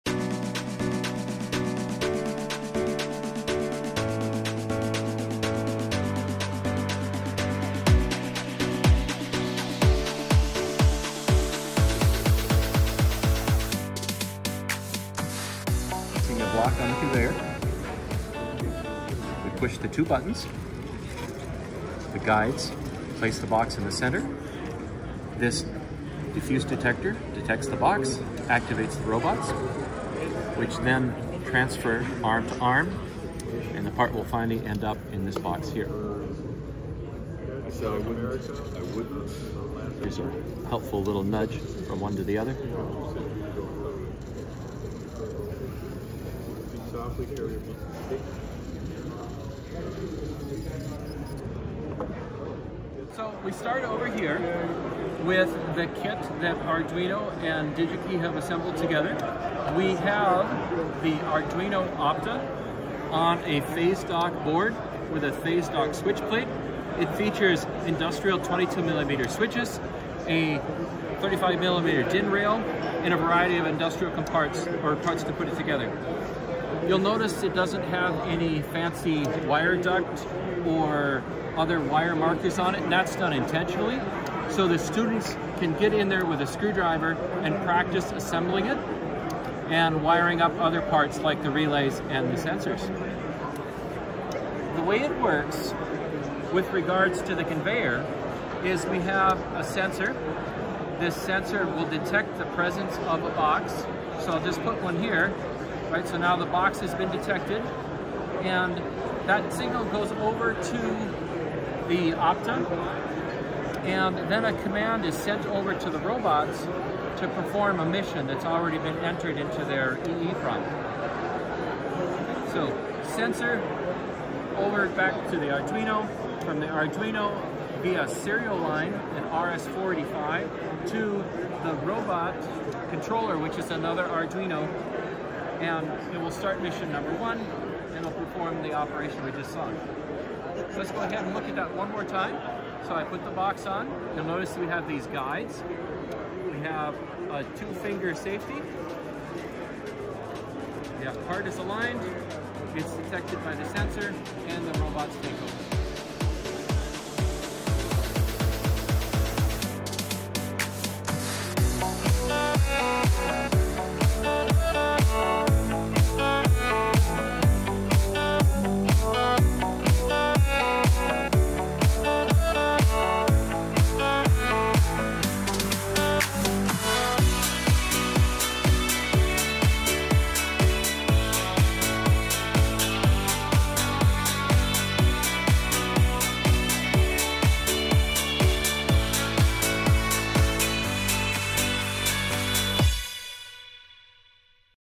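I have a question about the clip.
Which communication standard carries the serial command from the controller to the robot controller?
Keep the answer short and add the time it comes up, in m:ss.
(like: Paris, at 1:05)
RS-485, at 2:09.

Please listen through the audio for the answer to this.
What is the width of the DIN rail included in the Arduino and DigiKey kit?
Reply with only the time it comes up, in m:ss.
1:11.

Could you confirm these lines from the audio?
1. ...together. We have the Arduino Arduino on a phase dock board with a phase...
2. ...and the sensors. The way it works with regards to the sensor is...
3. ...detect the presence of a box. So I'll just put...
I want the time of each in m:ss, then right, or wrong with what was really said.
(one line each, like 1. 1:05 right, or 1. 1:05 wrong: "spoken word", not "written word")
1. 0:58 wrong: "Opta", not "Arduino"
2. 1:32 wrong: "conveyor", not "sensor"
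3. 1:41 right.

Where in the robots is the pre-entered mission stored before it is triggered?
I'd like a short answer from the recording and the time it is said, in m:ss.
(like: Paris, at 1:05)
EEPROM, at 2:00.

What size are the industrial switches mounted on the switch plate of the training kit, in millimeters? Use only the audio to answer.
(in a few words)
22 millimeter.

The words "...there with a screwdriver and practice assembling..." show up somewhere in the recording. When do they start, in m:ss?
1:26.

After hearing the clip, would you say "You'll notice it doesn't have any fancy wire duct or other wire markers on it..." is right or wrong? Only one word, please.
right.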